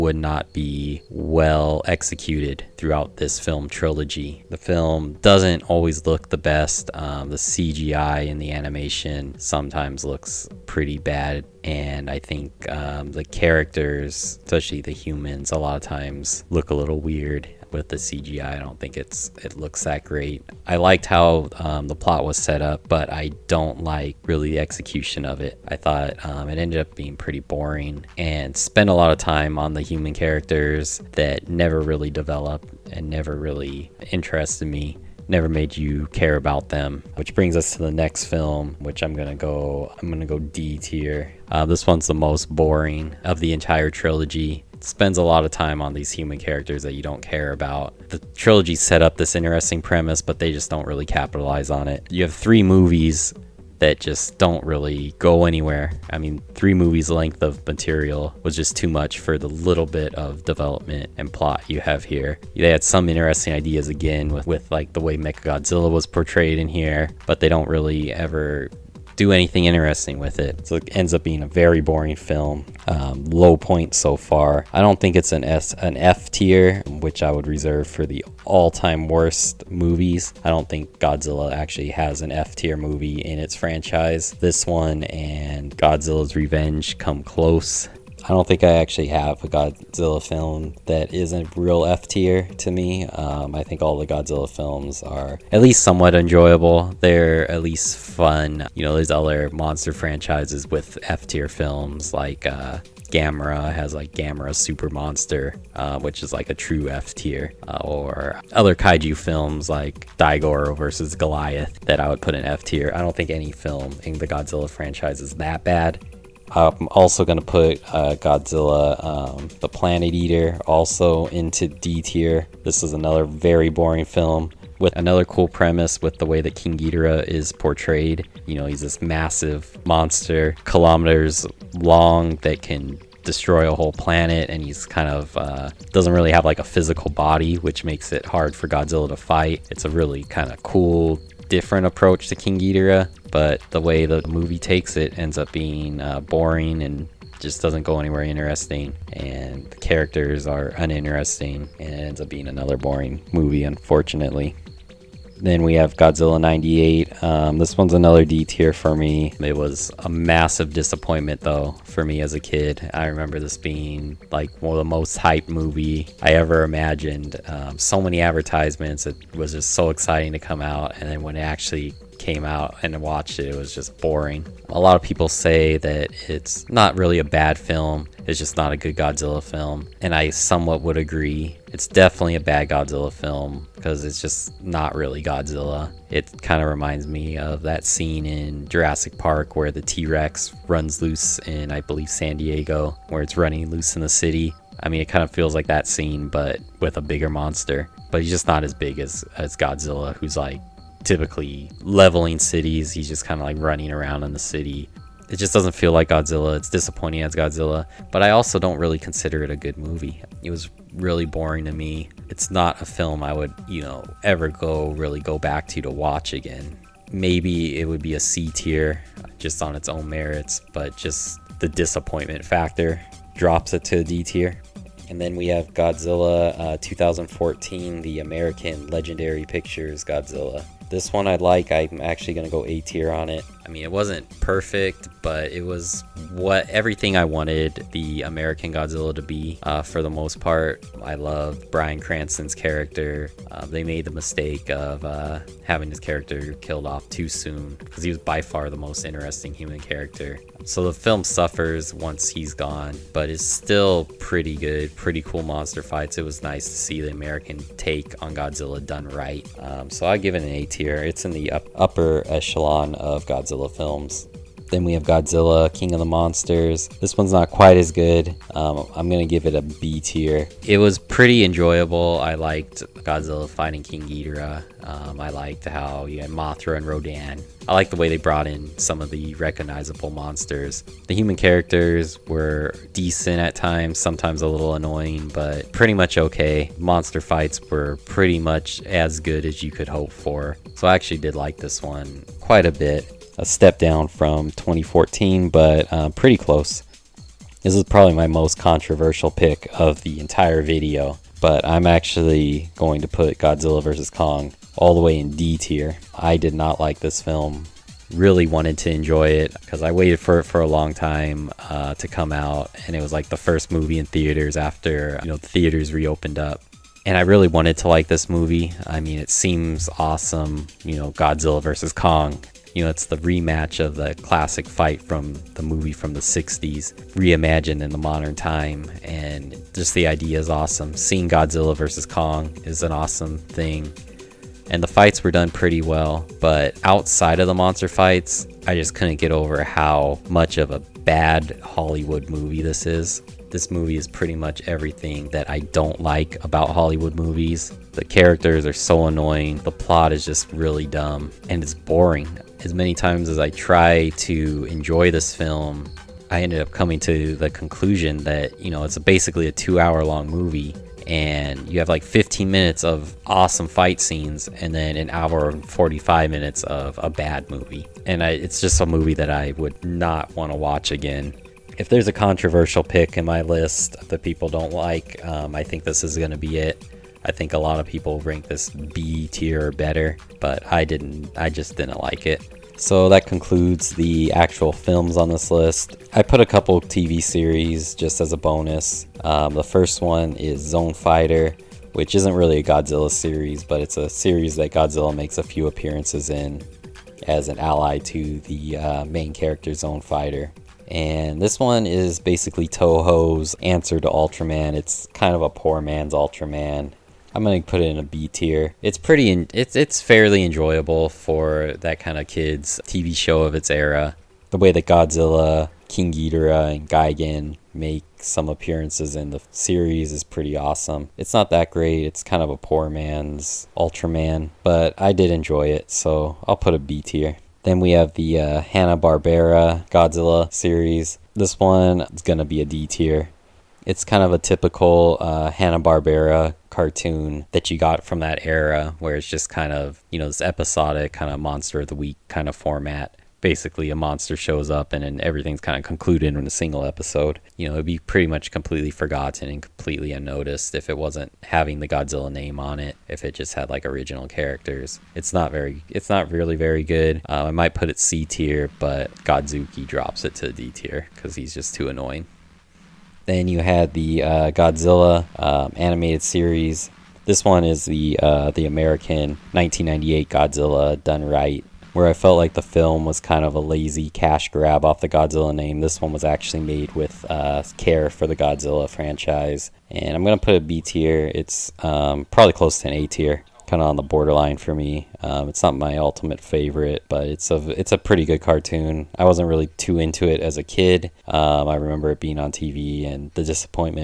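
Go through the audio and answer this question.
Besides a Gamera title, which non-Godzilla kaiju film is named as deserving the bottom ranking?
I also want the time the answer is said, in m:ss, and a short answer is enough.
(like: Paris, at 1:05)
Daigoro versus Goliath, at 1:50.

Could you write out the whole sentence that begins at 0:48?
The trilogy set up this interesting premise, but they just don't really capitalize on it.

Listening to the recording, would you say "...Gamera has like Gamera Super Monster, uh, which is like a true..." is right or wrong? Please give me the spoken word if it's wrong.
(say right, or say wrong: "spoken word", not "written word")
right.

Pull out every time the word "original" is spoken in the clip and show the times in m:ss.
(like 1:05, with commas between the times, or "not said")
7:33.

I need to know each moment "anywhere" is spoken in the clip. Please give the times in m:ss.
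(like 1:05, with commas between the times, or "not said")
0:55, 2:27.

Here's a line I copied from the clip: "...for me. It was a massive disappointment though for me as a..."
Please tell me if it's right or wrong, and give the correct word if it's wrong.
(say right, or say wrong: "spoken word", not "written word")
right.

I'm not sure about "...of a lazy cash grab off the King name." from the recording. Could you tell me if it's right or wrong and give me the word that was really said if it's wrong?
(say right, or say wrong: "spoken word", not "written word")
wrong: "Godzilla", not "King".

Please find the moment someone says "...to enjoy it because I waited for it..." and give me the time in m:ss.
5:08.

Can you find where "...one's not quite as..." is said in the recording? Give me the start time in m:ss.
4:27.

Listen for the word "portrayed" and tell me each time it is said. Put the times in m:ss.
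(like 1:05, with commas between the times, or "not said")
1:06, 2:07.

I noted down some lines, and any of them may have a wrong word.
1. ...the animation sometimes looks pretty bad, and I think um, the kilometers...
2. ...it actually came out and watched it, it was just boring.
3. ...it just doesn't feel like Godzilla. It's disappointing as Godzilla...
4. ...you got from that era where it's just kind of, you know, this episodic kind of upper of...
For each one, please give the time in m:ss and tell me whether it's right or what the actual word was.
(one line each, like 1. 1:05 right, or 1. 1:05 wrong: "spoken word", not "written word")
1. 0:08 wrong: "characters", not "kilometers"
2. 2:51 right
3. 3:25 right
4. 7:17 wrong: "monster", not "upper".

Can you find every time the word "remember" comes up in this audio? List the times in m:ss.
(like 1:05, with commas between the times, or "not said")
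2:43, 8:11.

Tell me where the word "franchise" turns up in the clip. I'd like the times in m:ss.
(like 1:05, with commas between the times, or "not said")
1:23, 1:39, 1:54, 7:58.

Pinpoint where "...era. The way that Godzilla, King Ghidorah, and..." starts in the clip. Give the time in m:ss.
6:53.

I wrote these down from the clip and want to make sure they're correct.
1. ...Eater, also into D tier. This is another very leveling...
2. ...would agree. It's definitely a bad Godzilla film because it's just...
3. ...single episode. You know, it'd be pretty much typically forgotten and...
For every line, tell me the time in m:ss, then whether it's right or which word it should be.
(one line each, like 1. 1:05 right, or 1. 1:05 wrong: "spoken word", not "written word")
1. 2:00 wrong: "boring", not "leveling"
2. 3:00 right
3. 7:26 wrong: "completely", not "typically".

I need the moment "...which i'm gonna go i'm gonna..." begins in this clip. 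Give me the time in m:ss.
0:38.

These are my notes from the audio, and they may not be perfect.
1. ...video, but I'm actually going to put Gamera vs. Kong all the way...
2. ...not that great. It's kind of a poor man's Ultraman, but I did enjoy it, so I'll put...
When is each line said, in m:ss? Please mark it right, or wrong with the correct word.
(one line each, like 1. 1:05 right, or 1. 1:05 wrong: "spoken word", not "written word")
1. 5:00 wrong: "Godzilla", not "Gamera"
2. 7:01 right.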